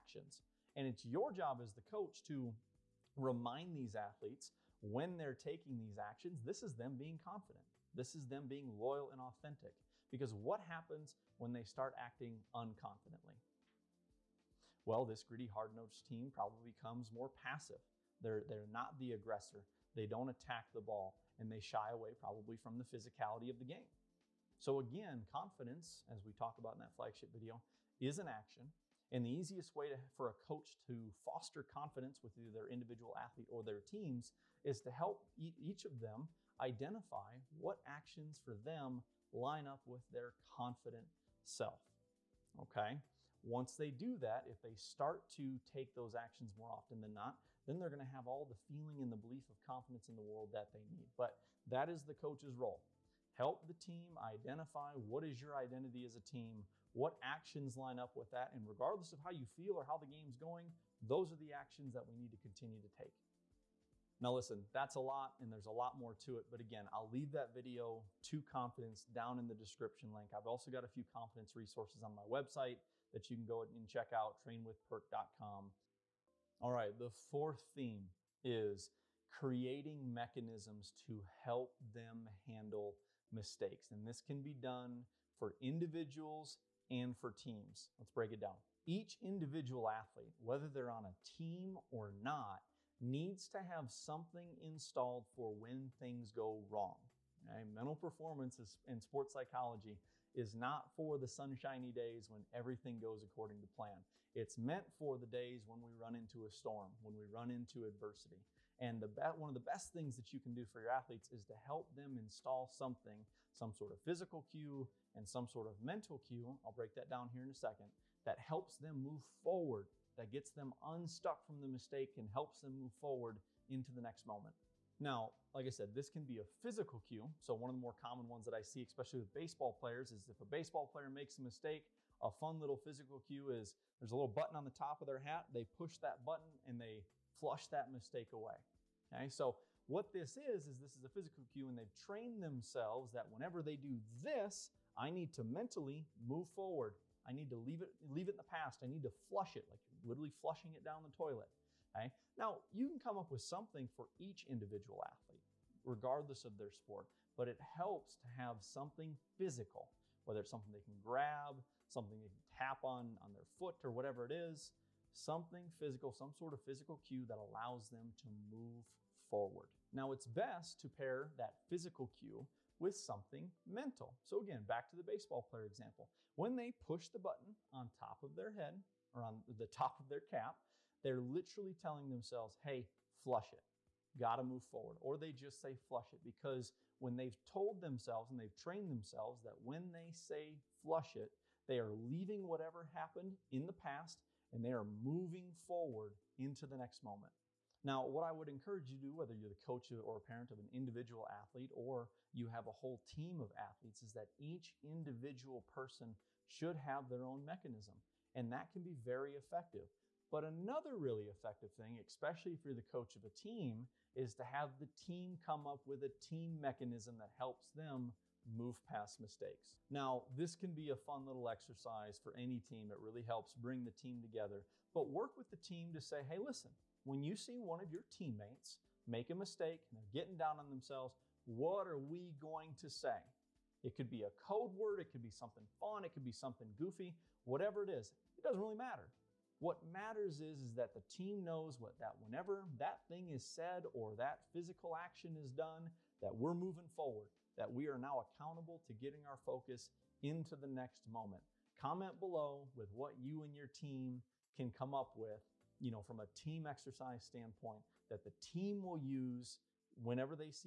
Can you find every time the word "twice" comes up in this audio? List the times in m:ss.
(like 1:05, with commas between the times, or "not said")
not said.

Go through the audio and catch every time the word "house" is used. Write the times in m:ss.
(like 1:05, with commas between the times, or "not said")
not said.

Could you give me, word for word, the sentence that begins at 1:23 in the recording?
And this can be done for individuals and for teams.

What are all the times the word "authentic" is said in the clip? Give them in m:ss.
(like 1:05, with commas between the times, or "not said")
0:09.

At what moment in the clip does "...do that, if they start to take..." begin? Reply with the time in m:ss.
0:43.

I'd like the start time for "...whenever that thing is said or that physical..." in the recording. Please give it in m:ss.
4:02.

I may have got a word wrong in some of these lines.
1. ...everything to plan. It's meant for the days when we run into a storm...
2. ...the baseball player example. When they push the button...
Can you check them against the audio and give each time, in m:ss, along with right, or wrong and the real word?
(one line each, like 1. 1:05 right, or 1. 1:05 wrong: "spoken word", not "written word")
1. 1:43 wrong: "according", not "everything"
2. 2:54 right.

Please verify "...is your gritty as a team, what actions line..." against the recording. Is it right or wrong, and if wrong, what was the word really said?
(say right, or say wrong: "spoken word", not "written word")
wrong: "identity", not "gritty".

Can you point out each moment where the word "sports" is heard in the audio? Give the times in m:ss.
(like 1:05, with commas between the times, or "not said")
1:39, 2:36.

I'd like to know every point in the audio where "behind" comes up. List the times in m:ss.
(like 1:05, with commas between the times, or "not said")
not said.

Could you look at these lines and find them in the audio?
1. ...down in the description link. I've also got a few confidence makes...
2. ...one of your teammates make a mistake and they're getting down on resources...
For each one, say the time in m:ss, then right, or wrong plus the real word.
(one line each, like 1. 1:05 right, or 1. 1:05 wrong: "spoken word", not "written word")
1. 1:09 wrong: "resources", not "makes"
2. 3:47 wrong: "themselves", not "resources".